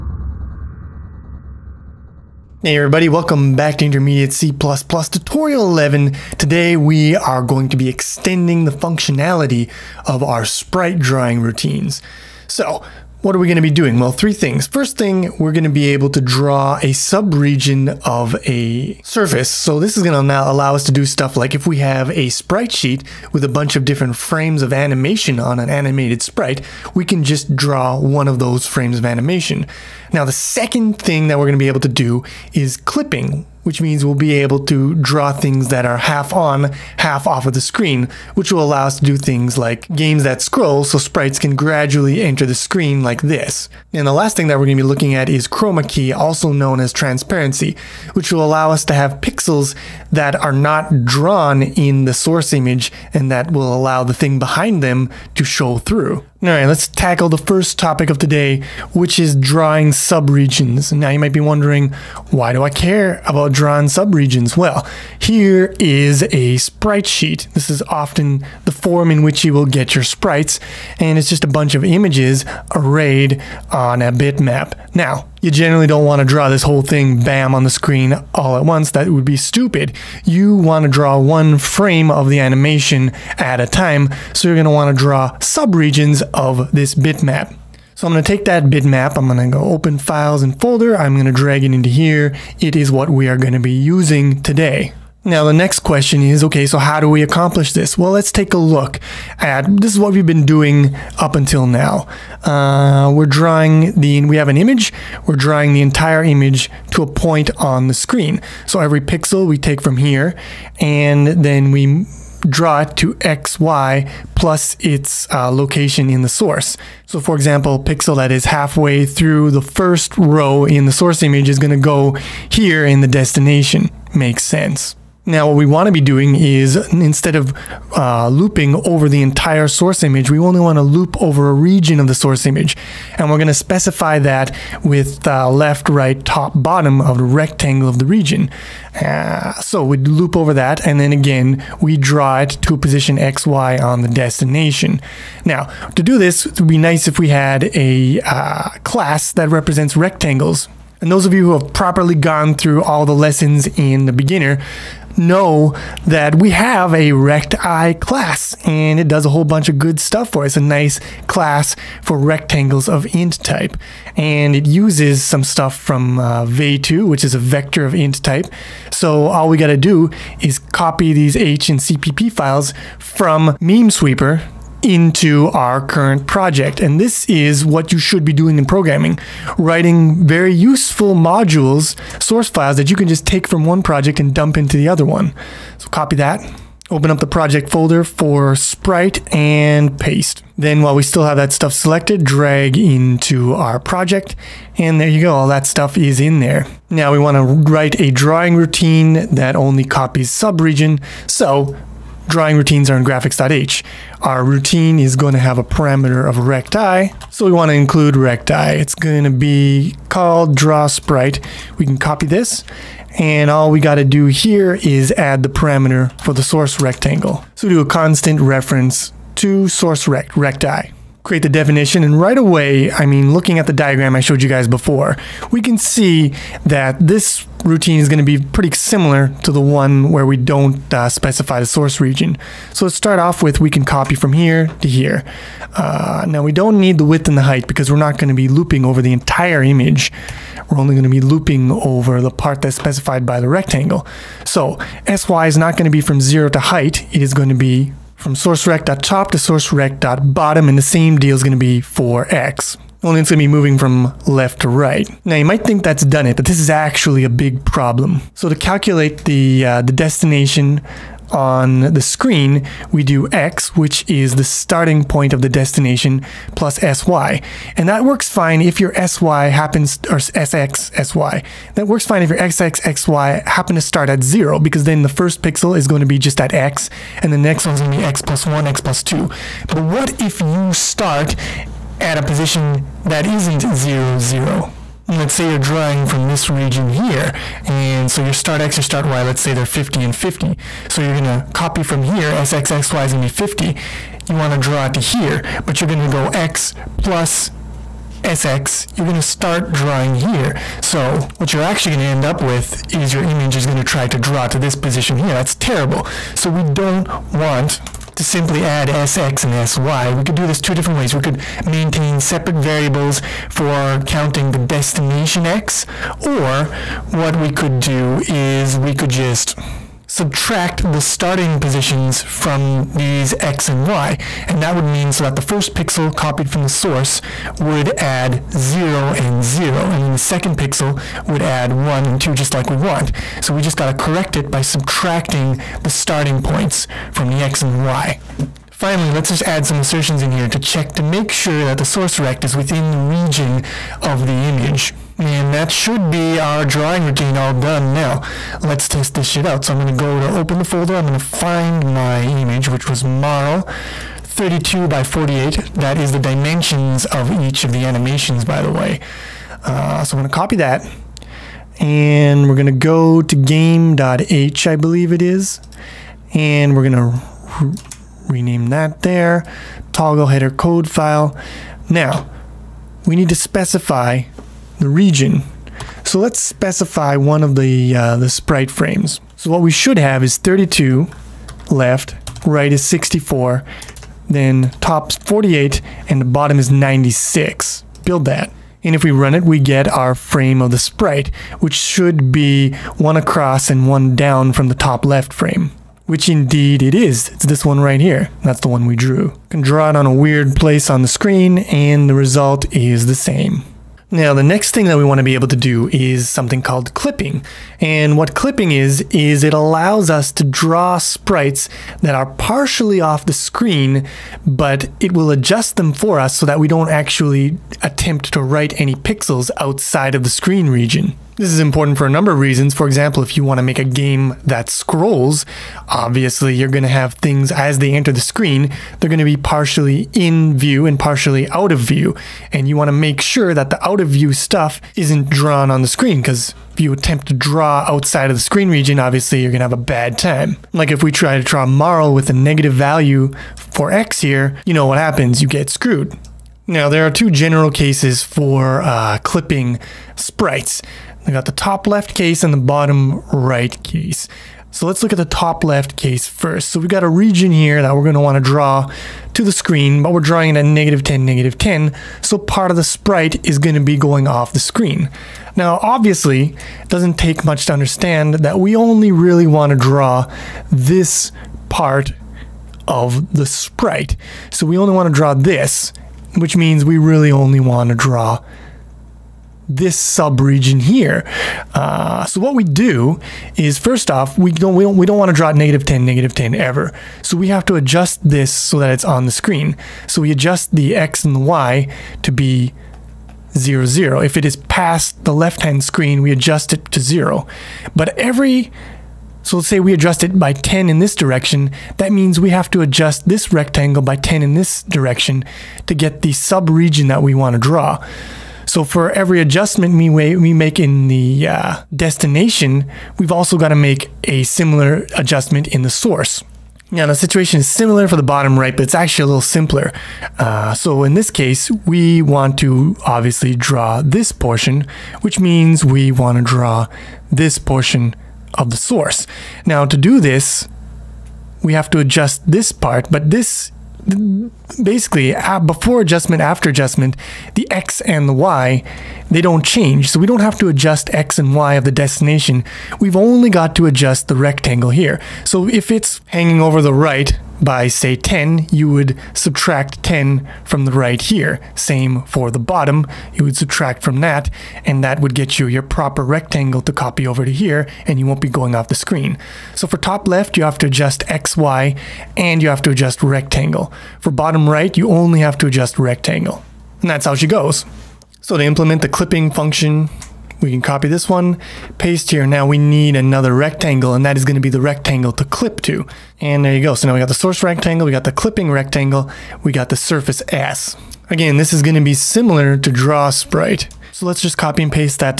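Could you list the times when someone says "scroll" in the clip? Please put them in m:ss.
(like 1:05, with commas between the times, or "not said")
0:40, 7:04.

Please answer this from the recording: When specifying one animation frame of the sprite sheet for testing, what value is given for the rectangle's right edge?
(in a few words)
64.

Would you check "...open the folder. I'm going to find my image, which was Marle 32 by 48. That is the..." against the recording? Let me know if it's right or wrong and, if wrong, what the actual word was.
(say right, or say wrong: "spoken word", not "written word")
right.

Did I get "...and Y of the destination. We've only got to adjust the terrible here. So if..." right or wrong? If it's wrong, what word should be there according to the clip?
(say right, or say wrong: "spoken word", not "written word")
wrong: "rectangle", not "terrible".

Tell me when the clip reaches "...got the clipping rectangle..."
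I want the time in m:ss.
9:38.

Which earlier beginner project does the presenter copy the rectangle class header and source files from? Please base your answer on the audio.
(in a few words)
Meme sweeper.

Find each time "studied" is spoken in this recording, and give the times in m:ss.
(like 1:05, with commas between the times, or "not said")
not said.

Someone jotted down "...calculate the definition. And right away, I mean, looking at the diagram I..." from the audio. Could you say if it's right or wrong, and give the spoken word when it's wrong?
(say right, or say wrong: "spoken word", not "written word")
wrong: "create", not "calculate".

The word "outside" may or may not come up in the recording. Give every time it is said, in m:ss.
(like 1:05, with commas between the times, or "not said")
6:59, 7:17.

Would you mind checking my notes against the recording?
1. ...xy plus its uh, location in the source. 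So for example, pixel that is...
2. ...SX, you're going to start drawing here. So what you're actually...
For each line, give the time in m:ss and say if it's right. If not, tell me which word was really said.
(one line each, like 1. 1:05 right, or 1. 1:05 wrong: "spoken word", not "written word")
1. 1:53 right
2. 4:58 right.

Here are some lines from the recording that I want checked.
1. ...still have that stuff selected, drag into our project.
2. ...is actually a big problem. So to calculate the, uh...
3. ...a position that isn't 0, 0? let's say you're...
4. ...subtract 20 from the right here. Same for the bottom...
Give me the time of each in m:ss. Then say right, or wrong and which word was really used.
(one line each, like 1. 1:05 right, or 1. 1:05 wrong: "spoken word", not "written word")
1. 3:11 right
2. 4:16 right
3. 4:42 right
4. 9:09 wrong: "10", not "20".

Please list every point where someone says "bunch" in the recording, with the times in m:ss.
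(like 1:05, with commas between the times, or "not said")
0:23, 1:11, 2:39.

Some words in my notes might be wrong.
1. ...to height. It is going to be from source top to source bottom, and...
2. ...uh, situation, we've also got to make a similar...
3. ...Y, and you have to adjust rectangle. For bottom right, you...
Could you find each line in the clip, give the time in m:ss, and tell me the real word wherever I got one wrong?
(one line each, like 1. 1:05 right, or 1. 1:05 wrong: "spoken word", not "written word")
1. 4:06 right
2. 8:31 wrong: "destination", not "situation"
3. 9:21 right.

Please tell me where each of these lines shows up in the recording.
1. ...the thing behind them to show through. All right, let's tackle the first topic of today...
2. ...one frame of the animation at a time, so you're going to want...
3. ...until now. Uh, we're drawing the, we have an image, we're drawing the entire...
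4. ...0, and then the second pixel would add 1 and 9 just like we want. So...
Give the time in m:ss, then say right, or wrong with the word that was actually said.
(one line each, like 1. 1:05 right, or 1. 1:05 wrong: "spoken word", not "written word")
1. 0:54 right
2. 1:21 right
3. 1:41 right
4. 5:29 wrong: "2", not "9".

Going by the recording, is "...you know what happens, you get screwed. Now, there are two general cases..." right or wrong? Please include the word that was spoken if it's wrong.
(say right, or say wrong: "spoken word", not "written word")
right.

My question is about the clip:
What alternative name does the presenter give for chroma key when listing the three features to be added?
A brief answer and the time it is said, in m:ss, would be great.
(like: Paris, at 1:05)
Transparency, at 0:46.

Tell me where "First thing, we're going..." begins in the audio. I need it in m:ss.
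0:14.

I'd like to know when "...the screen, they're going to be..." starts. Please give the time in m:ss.
7:08.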